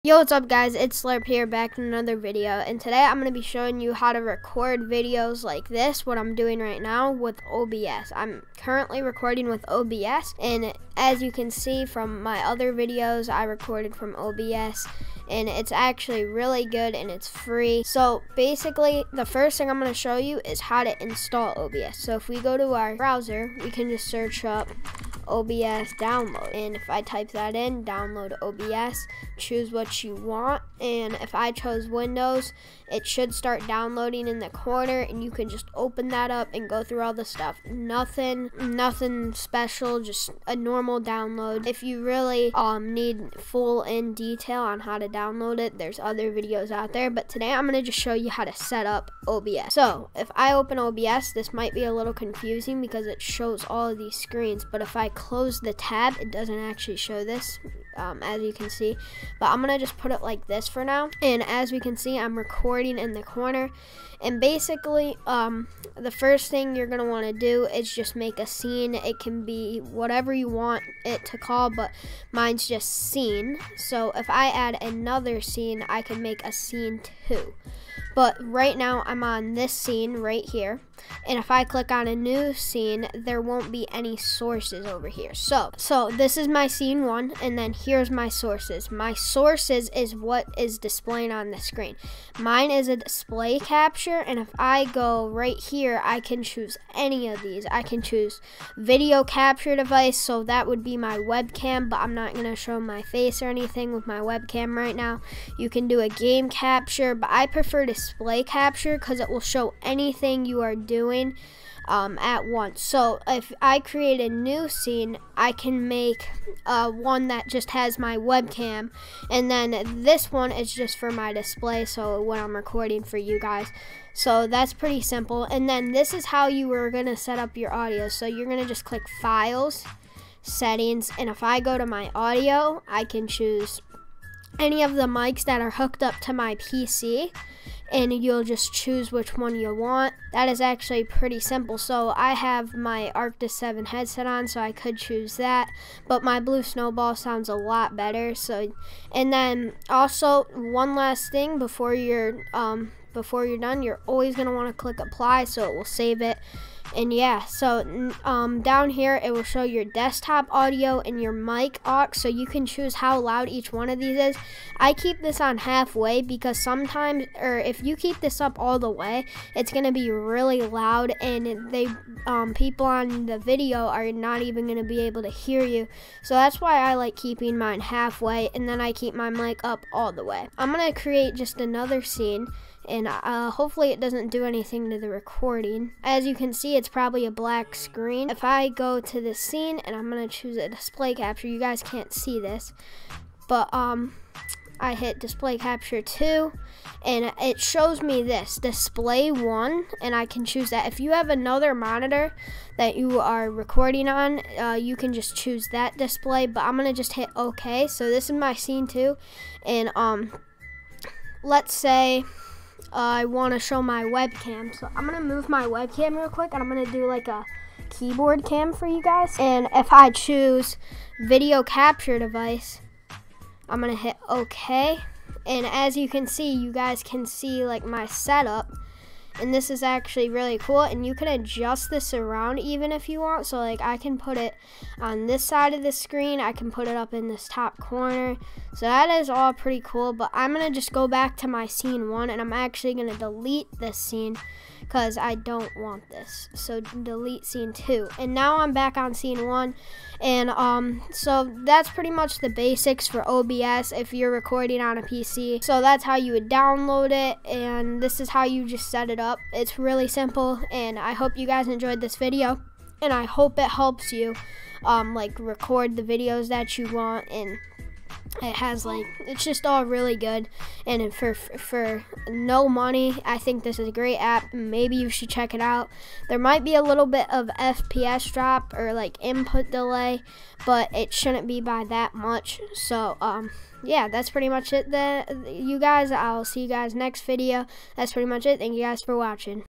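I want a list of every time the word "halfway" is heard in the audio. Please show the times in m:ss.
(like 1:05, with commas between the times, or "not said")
2:45, 2:57.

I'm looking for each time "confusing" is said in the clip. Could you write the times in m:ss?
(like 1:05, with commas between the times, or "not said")
0:52.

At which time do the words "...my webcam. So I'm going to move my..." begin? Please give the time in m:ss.
3:33.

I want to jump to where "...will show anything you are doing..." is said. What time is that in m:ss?
1:49.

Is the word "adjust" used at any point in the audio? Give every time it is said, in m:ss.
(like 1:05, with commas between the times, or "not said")
3:51.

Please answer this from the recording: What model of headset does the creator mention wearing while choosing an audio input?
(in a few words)
Arctis 7.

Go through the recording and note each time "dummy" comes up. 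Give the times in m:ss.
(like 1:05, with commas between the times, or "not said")
not said.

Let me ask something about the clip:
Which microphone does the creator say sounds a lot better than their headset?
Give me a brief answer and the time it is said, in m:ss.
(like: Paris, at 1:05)
Blue Snowball, at 2:26.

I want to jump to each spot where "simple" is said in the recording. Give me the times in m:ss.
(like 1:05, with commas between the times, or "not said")
2:05, 2:21, 4:20.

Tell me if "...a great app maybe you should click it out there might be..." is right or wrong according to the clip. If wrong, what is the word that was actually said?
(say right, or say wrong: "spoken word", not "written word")
wrong: "check", not "click".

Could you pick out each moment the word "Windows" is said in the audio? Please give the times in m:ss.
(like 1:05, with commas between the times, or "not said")
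0:31.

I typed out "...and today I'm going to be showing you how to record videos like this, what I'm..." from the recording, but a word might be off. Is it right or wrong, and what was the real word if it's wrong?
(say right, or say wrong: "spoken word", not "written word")
right.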